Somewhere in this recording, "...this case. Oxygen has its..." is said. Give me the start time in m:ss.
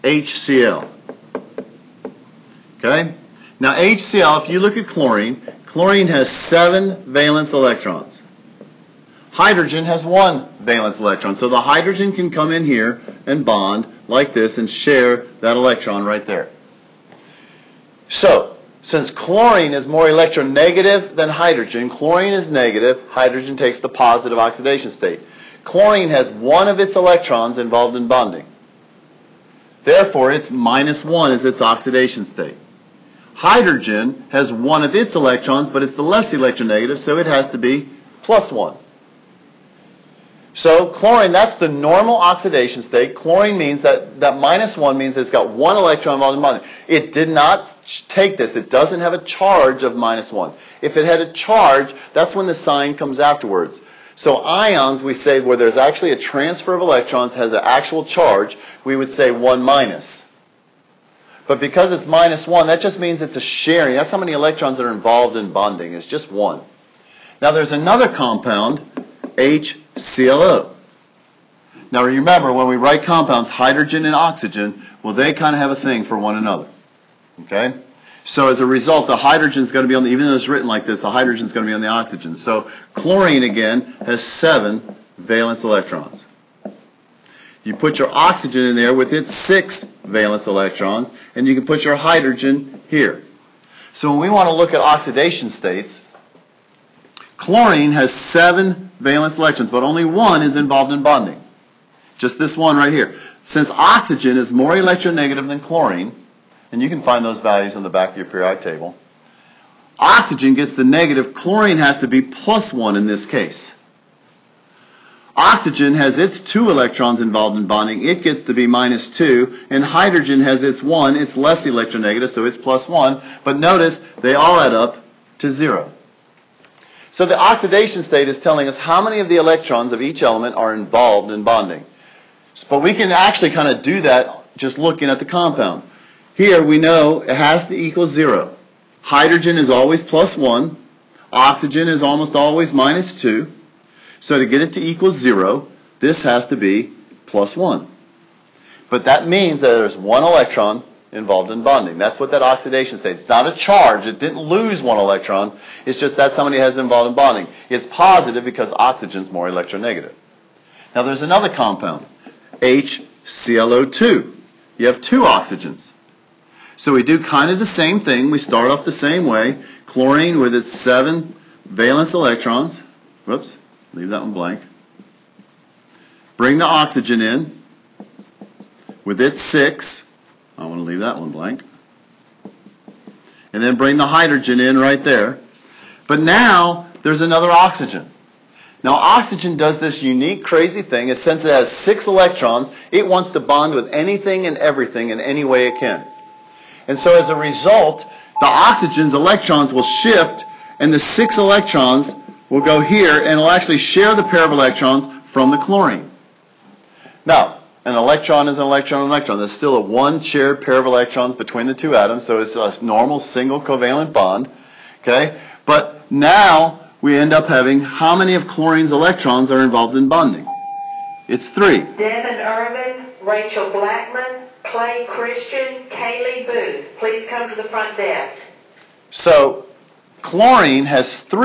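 1:53.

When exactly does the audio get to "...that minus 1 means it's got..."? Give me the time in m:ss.
0:44.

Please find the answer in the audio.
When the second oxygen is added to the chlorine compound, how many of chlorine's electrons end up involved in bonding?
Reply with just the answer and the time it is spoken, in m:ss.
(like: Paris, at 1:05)
3, at 3:41.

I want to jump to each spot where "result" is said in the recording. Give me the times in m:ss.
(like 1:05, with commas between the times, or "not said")
1:18, 3:17.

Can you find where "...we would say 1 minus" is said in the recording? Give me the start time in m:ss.
0:58.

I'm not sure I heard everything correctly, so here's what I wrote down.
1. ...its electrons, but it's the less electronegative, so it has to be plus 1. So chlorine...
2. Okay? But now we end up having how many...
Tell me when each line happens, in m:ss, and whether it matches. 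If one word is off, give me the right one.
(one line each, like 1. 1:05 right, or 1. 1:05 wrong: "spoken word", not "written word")
1. 0:34 right
2. 3:35 right.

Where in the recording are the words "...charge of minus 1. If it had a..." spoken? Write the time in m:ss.
0:49.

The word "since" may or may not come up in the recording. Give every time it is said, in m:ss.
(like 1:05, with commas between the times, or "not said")
0:18, 1:43, 3:11.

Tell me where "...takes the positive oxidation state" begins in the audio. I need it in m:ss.
0:23.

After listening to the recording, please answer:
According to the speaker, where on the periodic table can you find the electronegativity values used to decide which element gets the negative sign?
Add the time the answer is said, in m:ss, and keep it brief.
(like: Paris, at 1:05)
On the back, at 1:47.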